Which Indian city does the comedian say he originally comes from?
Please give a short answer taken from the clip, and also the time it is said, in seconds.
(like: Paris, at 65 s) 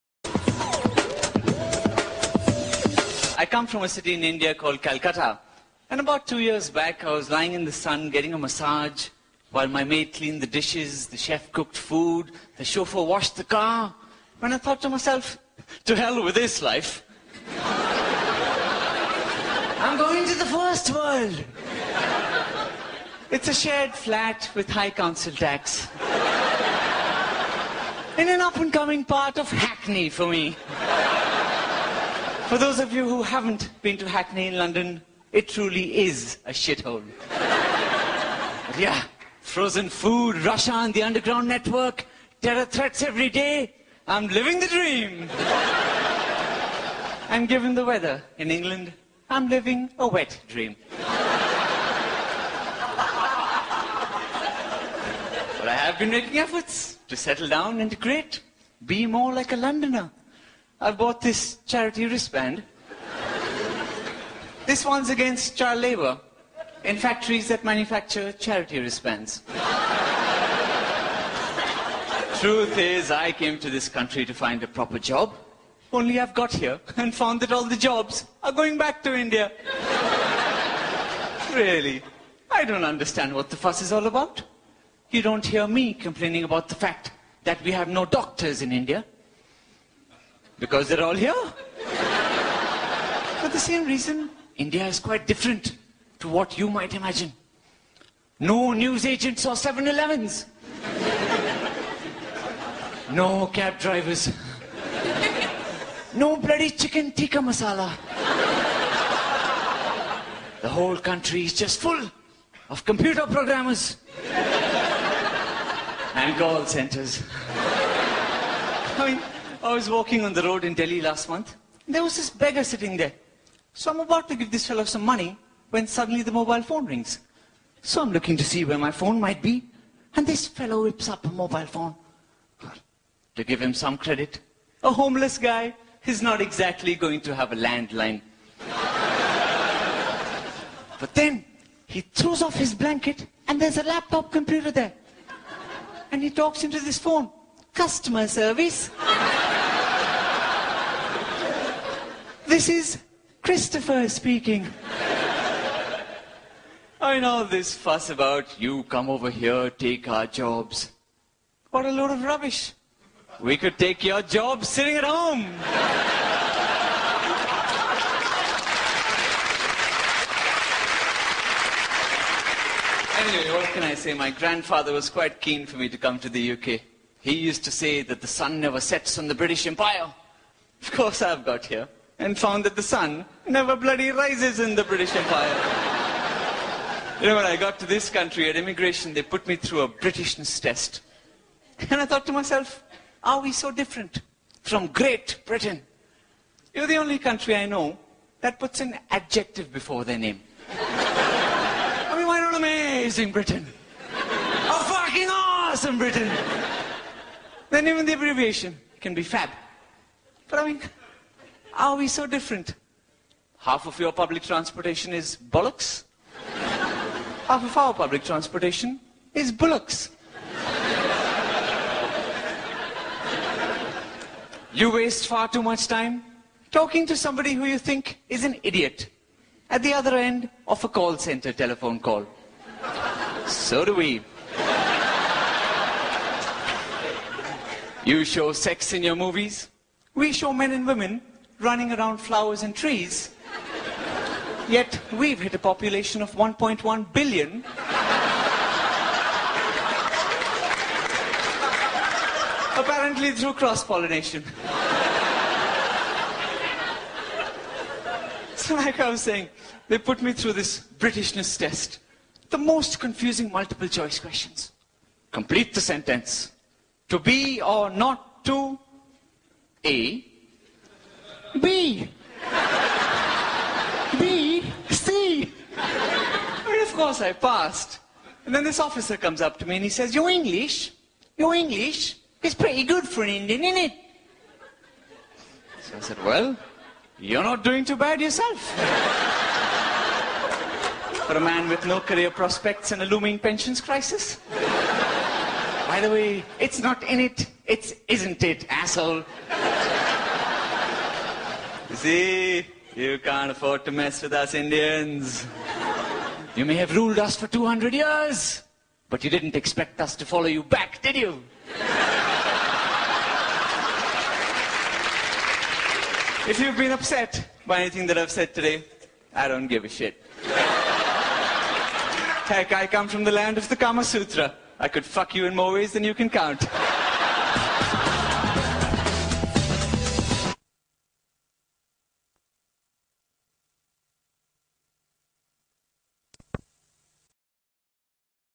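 Calcutta, at 4 s.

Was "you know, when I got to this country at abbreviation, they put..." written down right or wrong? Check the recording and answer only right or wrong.
wrong.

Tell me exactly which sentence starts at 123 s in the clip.
So I'm about to give this fellow some money when suddenly the mobile phone rings.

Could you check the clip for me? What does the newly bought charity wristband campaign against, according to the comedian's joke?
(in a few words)
child labor.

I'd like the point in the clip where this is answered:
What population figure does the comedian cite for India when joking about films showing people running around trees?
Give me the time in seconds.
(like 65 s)
246 s.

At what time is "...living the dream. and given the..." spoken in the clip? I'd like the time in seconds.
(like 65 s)
44 s.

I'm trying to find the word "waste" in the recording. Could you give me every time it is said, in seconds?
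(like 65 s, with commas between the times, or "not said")
224 s.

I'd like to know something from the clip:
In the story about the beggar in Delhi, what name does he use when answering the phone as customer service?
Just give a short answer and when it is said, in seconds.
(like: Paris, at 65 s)
Christopher, at 153 s.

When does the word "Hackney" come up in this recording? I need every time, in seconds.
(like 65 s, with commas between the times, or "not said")
29 s, 34 s.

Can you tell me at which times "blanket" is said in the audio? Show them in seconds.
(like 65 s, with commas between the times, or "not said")
142 s.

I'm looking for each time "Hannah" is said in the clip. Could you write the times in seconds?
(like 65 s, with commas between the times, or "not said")
not said.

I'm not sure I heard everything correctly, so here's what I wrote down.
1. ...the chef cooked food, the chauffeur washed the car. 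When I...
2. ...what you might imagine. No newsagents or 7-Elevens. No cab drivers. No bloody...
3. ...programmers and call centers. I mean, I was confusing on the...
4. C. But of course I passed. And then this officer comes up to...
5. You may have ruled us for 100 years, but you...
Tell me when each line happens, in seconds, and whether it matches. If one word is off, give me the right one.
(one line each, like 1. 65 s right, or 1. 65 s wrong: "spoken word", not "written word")
1. 11 s right
2. 96 s right
3. 113 s wrong: "walking", not "confusing"
4. 274 s right
5. 306 s wrong: "200", not "100".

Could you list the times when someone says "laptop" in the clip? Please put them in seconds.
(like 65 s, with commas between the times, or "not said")
143 s.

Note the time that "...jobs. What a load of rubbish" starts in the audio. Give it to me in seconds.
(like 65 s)
160 s.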